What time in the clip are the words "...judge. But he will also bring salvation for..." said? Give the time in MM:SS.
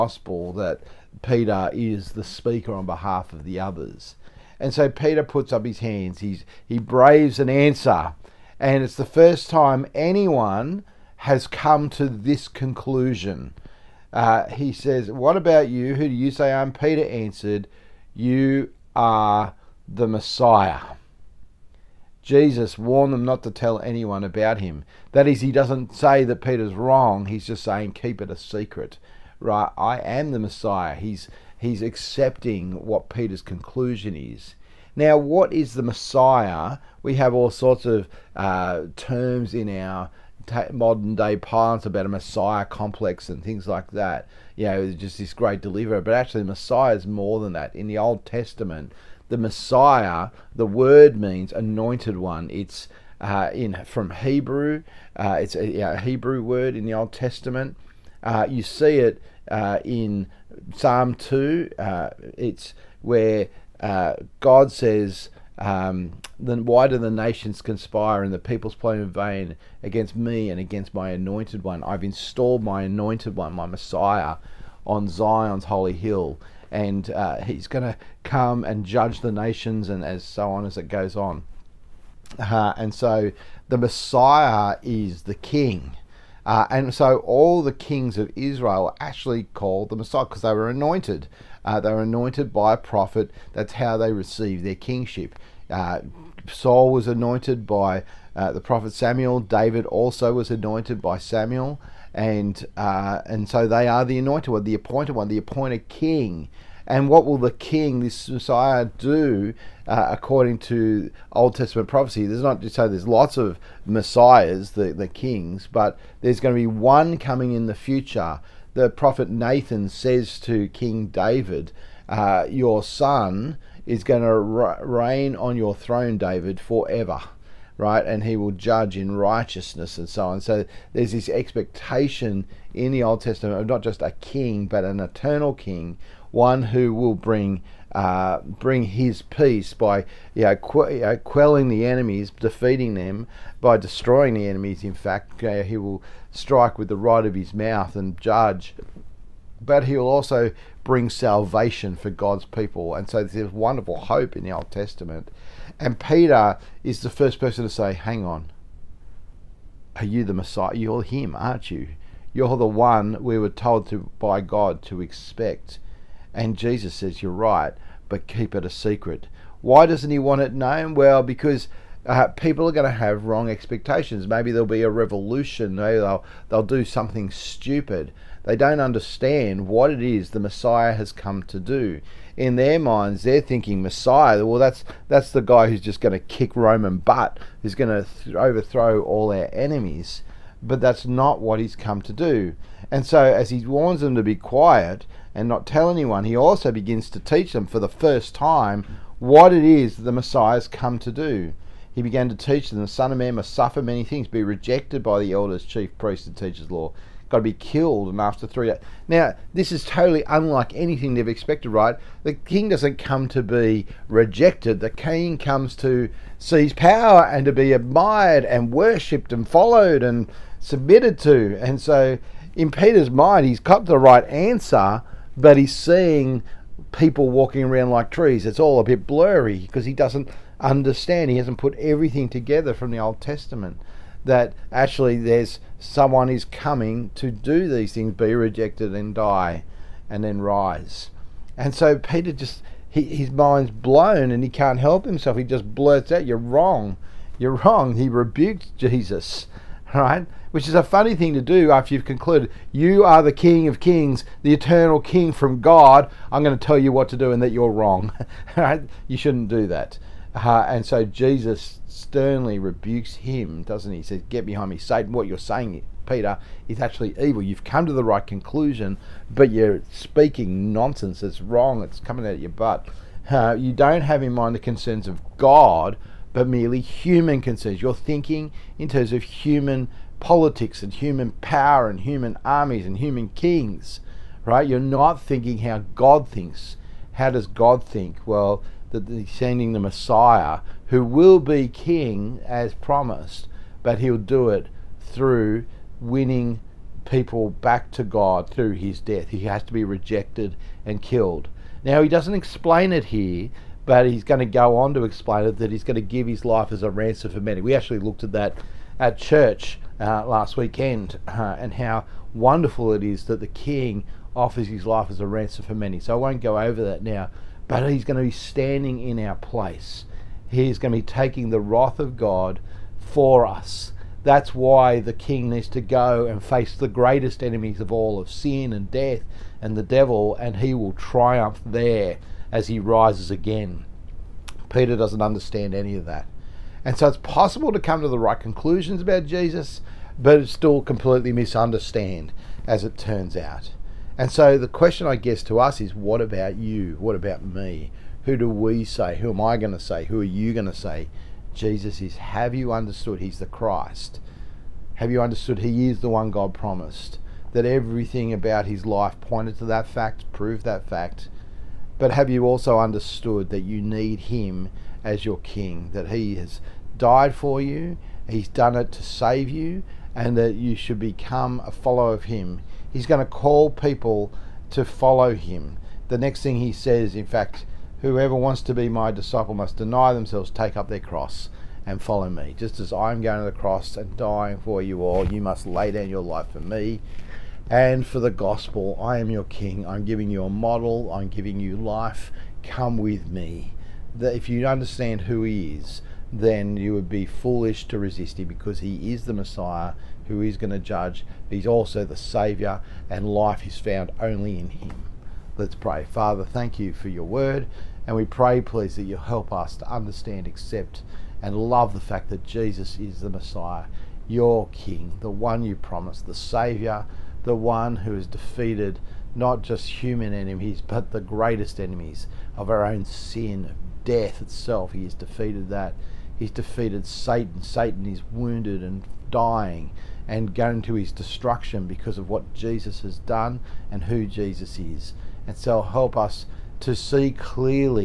02:28.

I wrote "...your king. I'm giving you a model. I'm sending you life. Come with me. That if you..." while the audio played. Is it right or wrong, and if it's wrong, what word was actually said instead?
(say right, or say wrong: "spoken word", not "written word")
wrong: "giving", not "sending".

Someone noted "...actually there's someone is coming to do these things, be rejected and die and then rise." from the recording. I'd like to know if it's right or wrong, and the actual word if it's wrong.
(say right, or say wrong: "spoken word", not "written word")
right.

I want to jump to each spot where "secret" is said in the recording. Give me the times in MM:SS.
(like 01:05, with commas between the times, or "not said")
00:28, 02:48.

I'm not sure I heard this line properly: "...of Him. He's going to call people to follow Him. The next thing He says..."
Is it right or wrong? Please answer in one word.
right.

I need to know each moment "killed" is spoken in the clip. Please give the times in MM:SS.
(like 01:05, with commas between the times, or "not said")
03:27, 05:01.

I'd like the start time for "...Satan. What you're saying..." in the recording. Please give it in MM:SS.
04:24.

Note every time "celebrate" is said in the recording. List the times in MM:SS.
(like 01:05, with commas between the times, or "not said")
not said.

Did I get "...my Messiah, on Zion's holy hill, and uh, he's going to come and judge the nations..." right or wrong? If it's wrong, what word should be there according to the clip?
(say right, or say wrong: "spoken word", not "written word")
right.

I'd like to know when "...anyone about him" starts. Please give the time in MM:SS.
00:23.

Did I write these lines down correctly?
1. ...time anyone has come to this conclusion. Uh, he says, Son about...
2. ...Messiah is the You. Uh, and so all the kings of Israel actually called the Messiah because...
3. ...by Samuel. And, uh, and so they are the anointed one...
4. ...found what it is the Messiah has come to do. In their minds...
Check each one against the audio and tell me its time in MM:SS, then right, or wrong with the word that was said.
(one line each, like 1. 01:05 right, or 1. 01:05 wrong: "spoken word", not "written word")
1. 00:09 wrong: "What", not "Son"
2. 01:23 wrong: "King", not "You"
3. 01:41 right
4. 02:58 wrong: "understand", not "found".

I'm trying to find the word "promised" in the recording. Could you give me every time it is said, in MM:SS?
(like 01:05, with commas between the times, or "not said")
04:52, 05:56, 06:55.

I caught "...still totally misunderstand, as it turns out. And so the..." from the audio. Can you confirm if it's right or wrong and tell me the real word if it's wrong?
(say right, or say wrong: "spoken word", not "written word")
wrong: "completely", not "totally".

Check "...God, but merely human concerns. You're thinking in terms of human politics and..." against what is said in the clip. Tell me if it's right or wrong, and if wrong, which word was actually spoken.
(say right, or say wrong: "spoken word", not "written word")
right.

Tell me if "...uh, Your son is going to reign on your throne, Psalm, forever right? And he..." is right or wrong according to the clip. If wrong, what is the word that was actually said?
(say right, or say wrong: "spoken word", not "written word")
wrong: "David", not "Psalm".